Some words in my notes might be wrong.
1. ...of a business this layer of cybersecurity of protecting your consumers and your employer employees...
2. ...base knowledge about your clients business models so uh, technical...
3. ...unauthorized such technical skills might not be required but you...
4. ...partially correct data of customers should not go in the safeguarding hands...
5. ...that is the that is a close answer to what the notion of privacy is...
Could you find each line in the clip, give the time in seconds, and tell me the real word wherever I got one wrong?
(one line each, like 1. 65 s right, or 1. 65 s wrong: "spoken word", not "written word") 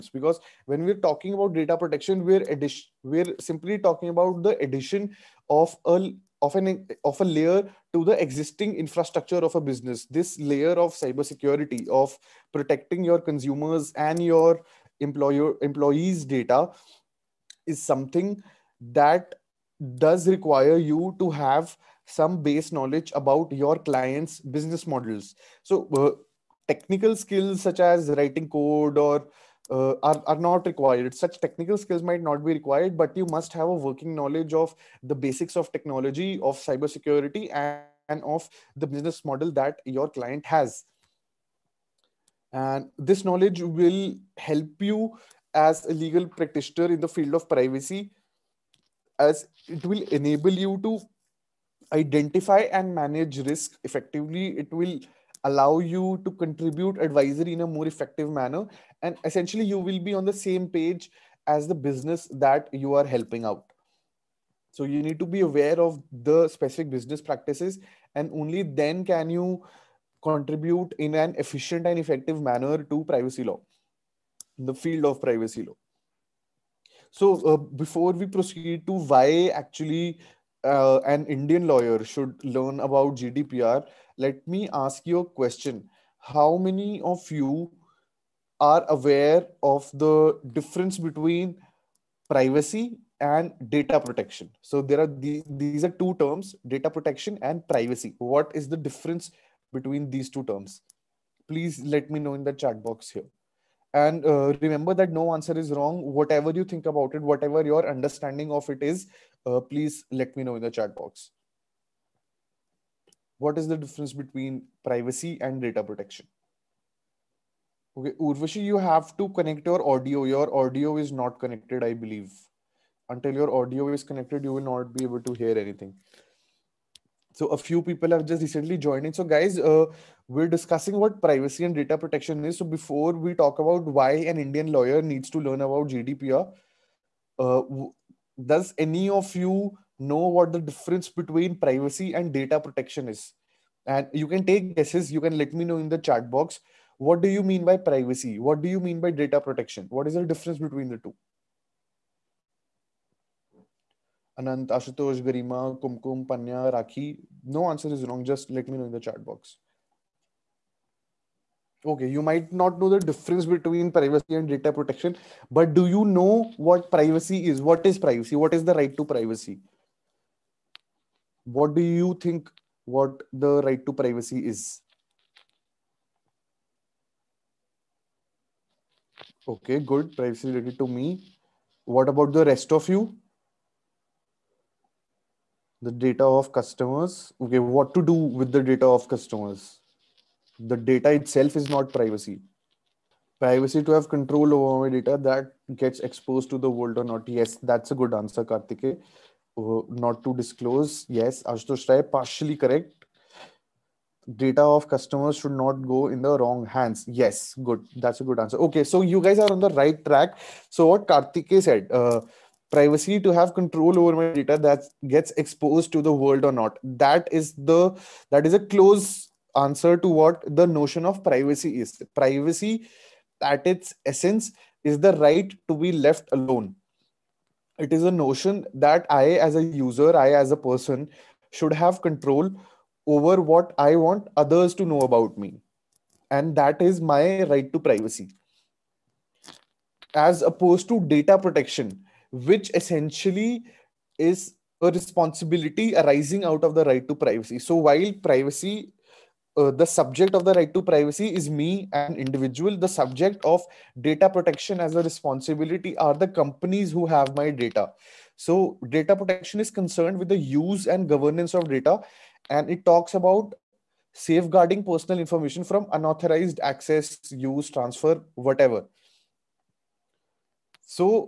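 1. 9 s right
2. 22 s right
3. 30 s wrong: "required", not "unauthorized"
4. 202 s wrong: "wrong", not "safeguarding"
5. 216 s right.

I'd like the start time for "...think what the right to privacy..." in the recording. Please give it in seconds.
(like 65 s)
172 s.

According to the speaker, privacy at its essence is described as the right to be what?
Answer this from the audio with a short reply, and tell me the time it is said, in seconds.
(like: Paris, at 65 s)
left alone, at 225 s.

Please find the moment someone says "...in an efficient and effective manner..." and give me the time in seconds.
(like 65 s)
70 s.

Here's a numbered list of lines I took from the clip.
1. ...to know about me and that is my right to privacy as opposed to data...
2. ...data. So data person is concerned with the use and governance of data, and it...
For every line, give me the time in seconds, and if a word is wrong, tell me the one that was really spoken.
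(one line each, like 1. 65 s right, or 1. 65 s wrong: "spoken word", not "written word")
1. 234 s right
2. 257 s wrong: "protection", not "person".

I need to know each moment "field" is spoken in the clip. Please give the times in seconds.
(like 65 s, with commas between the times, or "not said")
47 s, 74 s.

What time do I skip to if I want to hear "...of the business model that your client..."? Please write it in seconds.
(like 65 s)
38 s.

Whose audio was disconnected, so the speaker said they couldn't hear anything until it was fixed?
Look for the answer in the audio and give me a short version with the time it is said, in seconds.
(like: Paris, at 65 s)
Urvashi, at 118 s.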